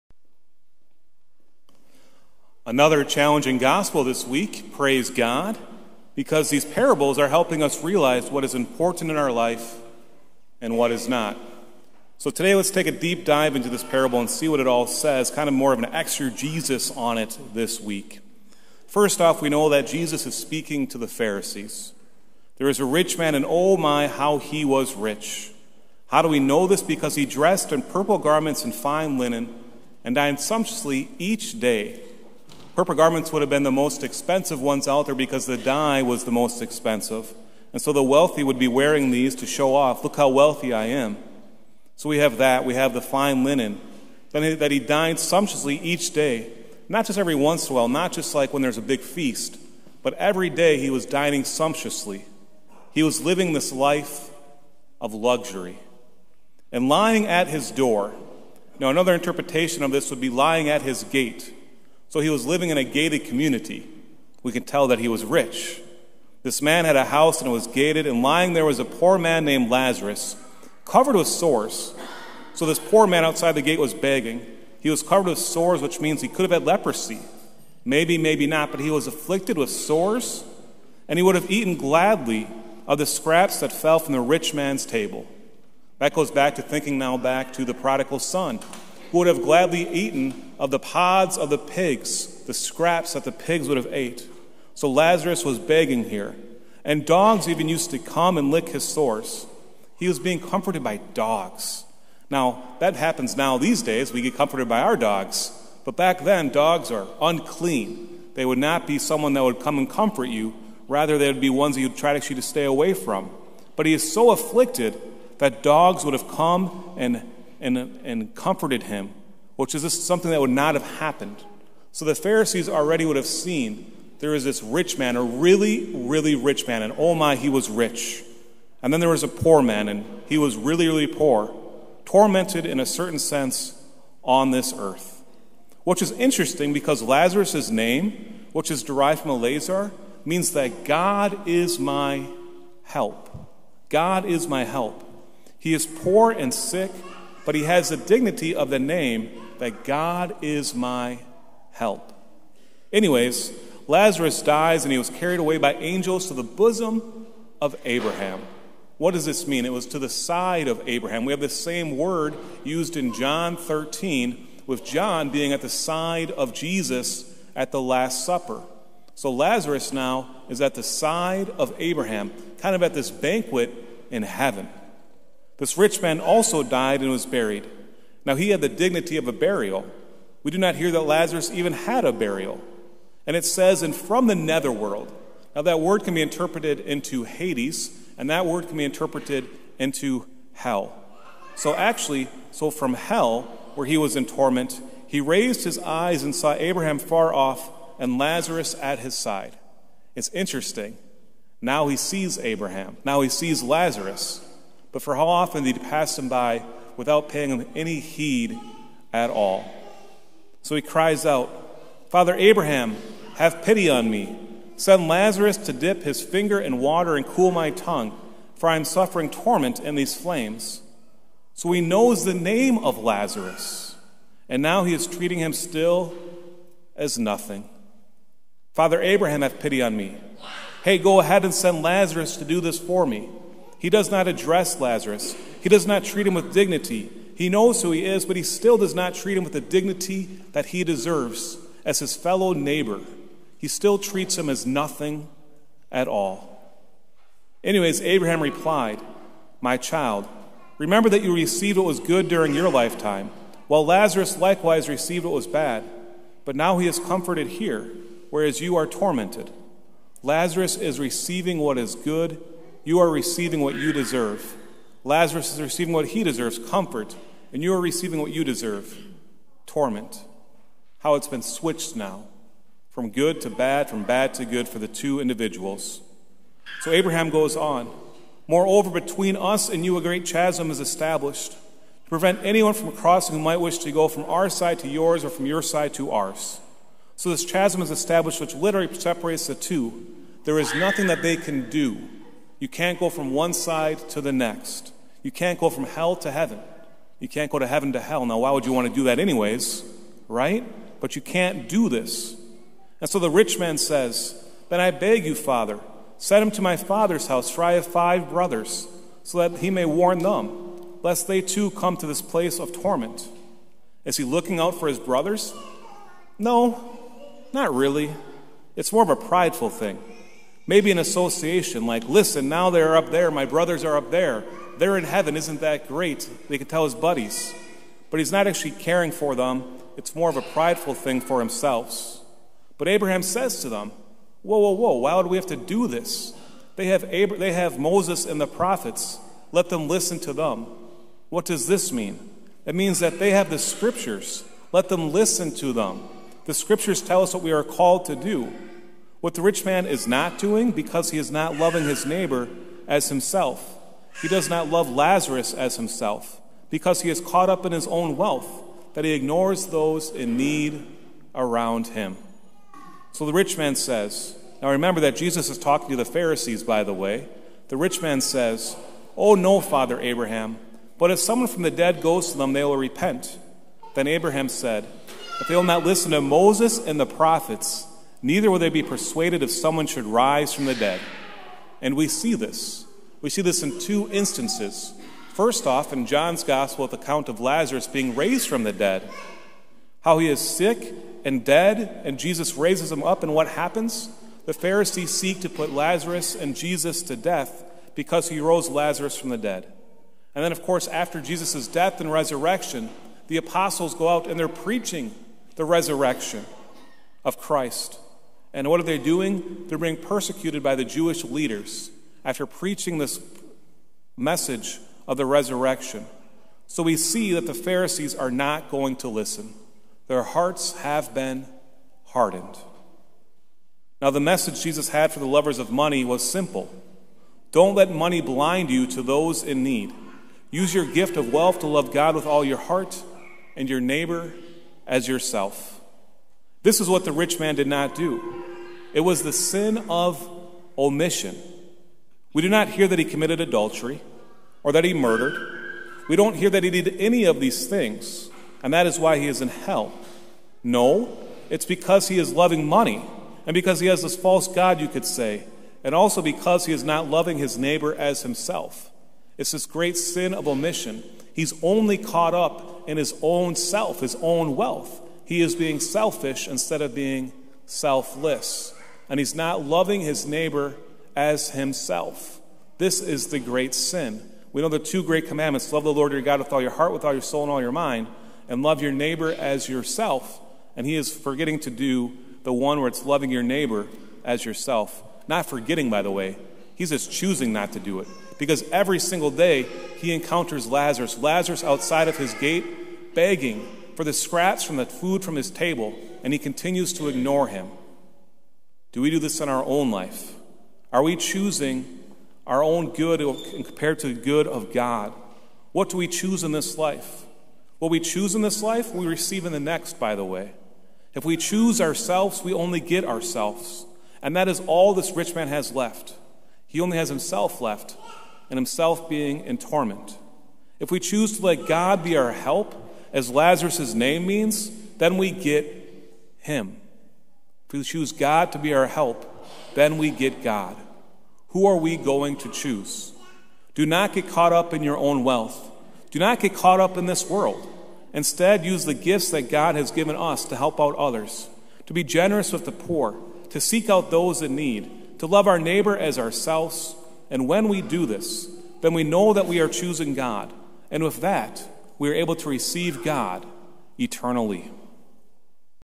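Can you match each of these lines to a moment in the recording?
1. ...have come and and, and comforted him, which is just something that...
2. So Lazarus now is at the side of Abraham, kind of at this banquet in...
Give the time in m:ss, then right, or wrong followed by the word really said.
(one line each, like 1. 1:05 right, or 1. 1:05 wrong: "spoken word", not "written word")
1. 1:56 right
2. 2:49 right.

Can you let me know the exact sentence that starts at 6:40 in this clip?
And then, of course, after Jesus' death and resurrection, the apostles go out and they're preaching the resurrection of Christ.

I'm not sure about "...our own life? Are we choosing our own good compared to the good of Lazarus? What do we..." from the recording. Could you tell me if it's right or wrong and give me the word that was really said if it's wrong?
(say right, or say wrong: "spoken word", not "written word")
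wrong: "God", not "Lazarus".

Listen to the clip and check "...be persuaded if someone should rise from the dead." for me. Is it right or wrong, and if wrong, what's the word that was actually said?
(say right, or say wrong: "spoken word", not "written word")
right.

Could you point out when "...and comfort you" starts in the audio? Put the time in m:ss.
1:49.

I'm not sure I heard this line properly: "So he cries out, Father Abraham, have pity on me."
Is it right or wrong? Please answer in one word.
right.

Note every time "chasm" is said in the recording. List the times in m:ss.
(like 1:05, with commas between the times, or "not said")
4:40, 4:47.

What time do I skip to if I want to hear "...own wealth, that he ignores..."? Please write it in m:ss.
5:57.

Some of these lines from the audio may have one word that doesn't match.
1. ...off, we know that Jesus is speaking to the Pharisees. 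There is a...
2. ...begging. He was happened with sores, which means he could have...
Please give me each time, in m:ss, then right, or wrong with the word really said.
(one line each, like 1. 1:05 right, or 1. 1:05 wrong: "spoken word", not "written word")
1. 0:19 right
2. 1:13 wrong: "covered", not "happened".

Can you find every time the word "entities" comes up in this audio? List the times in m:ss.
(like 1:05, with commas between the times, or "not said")
not said.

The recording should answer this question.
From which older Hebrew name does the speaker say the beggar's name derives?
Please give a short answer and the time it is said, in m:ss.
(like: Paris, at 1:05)
Elazar, at 2:19.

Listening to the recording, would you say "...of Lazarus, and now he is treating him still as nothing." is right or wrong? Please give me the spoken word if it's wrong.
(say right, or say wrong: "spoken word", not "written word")
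right.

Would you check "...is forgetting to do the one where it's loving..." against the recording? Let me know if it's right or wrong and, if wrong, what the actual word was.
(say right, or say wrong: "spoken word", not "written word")
right.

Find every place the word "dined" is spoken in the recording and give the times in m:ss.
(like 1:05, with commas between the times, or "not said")
0:30, 0:44.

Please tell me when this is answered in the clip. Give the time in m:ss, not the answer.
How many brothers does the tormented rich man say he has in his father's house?
5:07.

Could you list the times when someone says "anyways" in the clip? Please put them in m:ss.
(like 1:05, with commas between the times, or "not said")
2:32, 4:07, 4:59.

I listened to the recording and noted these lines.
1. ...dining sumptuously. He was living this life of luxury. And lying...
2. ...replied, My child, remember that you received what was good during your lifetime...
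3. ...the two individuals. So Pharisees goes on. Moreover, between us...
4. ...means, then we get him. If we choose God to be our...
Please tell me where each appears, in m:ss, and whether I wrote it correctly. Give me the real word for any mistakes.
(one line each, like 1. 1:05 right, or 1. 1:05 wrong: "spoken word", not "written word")
1. 0:51 right
2. 4:08 right
3. 4:34 wrong: "Abraham", not "Pharisees"
4. 8:44 right.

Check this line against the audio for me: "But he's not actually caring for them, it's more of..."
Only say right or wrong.
right.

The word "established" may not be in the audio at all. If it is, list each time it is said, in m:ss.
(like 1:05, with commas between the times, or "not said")
4:40, 4:47.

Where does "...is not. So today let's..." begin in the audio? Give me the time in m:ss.
0:10.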